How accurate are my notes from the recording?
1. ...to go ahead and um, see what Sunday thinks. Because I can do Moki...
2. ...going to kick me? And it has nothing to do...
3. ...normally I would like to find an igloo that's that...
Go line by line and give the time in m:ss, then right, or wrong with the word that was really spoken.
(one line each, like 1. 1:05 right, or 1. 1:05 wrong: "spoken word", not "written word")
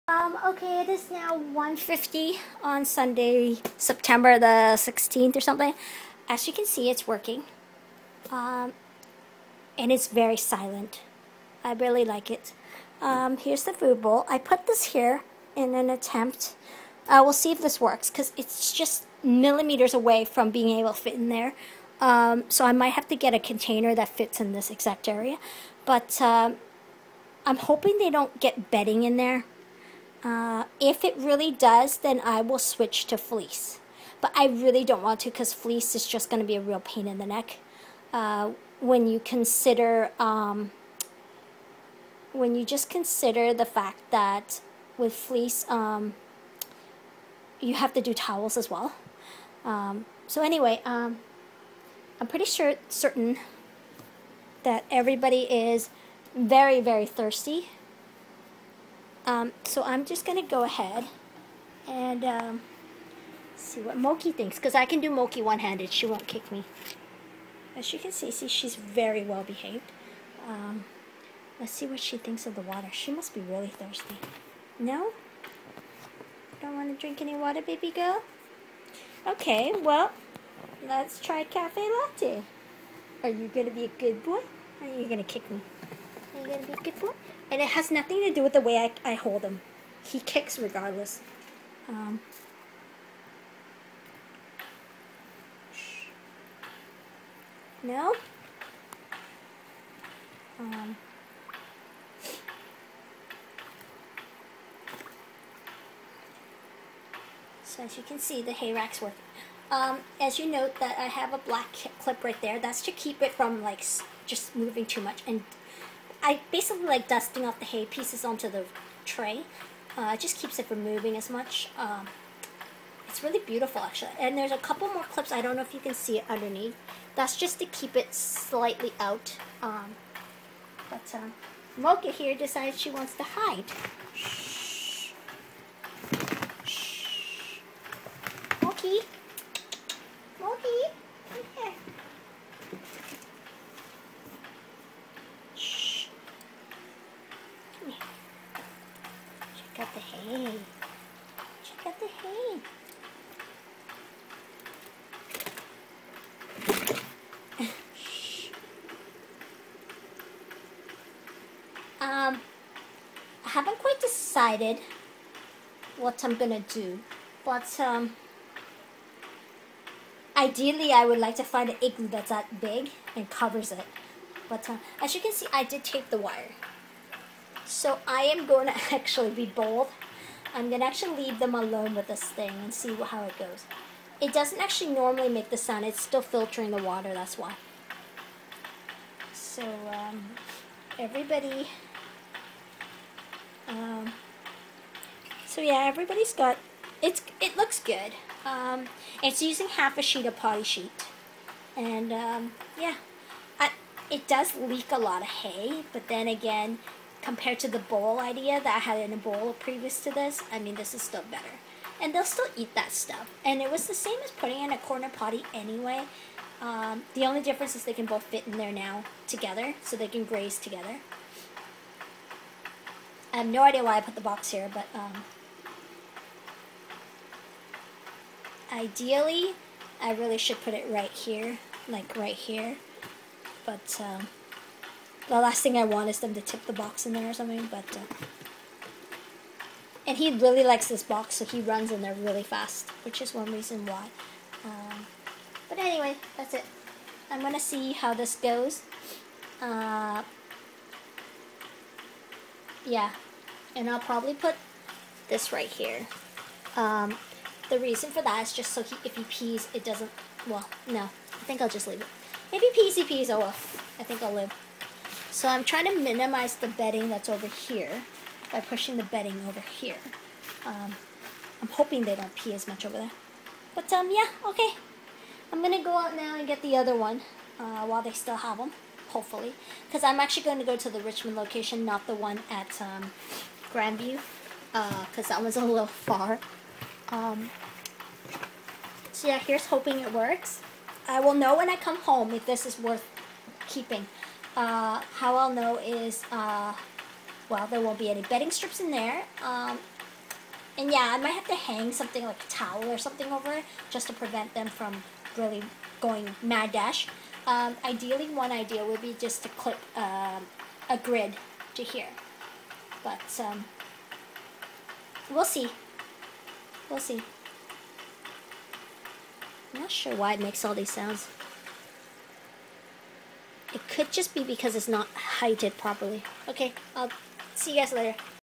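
1. 1:00 wrong: "Moki", not "Sunday"
2. 1:25 right
3. 2:50 wrong: "ideally", not "normally".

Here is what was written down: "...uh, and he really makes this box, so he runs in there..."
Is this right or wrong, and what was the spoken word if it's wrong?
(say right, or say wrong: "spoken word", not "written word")
wrong: "likes", not "makes".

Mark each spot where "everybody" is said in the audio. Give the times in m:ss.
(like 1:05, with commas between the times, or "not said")
0:54, 3:10, 3:15.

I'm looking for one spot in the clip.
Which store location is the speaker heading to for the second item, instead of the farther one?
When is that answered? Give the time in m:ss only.
4:40.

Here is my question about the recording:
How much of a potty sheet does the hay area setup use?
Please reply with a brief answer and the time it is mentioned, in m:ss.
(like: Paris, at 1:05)
Half a sheet, at 3:19.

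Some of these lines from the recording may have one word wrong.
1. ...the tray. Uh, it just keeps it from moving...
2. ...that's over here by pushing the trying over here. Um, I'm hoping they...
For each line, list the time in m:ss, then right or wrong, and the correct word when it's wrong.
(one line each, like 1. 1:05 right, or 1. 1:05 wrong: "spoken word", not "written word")
1. 1:58 right
2. 4:27 wrong: "bedding", not "trying".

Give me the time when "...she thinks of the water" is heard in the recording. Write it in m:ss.
1:11.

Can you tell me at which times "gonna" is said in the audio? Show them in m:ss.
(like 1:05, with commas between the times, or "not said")
2:46, 3:00, 4:07.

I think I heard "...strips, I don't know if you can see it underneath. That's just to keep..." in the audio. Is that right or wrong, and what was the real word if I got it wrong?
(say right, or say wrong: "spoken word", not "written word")
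wrong: "clips", not "strips".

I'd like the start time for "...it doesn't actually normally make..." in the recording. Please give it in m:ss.
3:04.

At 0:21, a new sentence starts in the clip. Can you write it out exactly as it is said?
Um, so I might have to get a container that fits in this exact area.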